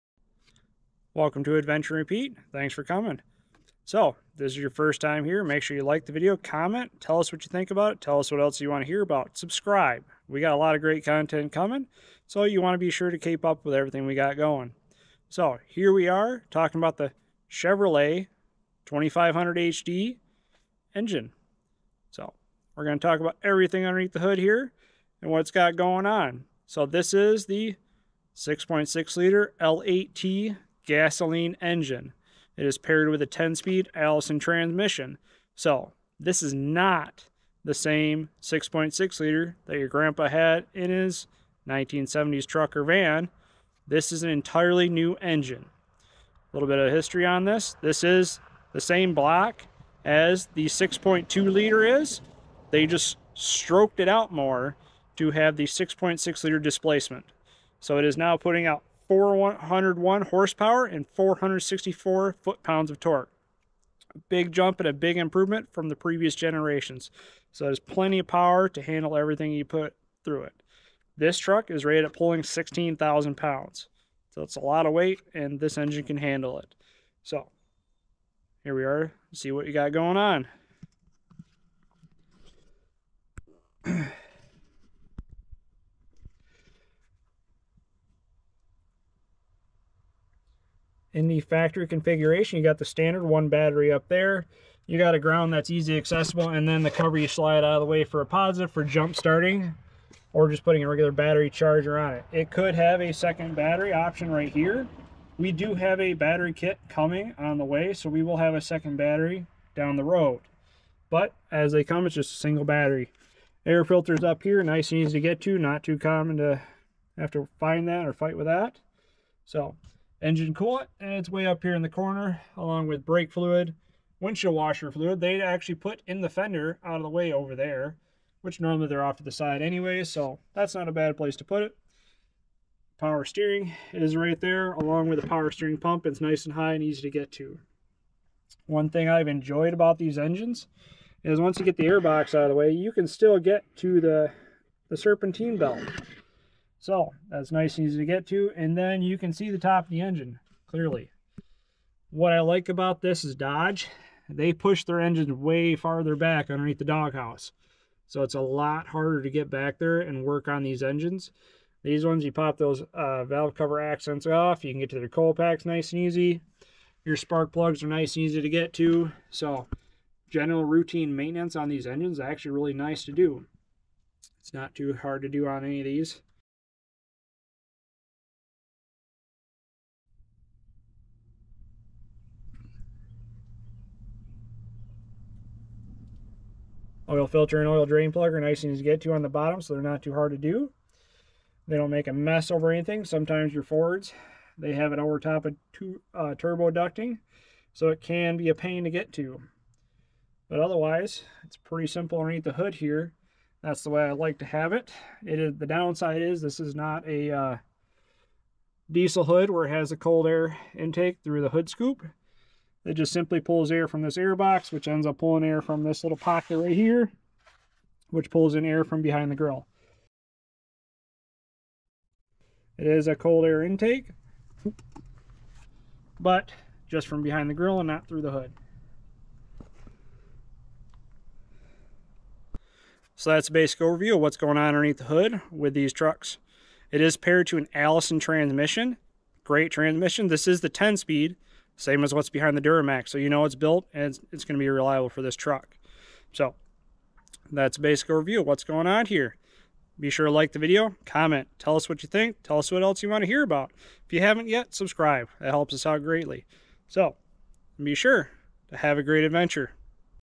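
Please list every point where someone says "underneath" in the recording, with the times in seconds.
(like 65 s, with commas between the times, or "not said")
23 s, 156 s, 202 s, 234 s.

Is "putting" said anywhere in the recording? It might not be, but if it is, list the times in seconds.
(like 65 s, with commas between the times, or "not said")
58 s, 100 s.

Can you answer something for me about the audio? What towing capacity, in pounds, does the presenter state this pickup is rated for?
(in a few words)
16,000 pounds.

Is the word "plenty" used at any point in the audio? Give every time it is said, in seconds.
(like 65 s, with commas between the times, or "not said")
67 s.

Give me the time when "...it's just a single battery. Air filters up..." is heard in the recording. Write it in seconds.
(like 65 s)
112 s.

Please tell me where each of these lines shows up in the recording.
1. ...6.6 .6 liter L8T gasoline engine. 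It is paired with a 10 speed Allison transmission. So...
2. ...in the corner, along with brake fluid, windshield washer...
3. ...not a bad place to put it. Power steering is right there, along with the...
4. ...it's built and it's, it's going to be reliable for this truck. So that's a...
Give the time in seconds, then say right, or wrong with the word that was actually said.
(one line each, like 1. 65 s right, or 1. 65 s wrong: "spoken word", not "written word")
1. 28 s right
2. 121 s right
3. 130 s right
4. 243 s right.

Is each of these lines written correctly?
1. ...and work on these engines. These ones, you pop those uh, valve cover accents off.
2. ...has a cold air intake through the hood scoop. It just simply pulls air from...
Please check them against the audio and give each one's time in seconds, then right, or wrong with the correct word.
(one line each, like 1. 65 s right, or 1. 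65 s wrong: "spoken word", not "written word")
1. 160 s right
2. 209 s right.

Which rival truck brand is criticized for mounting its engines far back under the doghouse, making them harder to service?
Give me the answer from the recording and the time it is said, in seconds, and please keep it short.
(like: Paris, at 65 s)
Dodge, at 153 s.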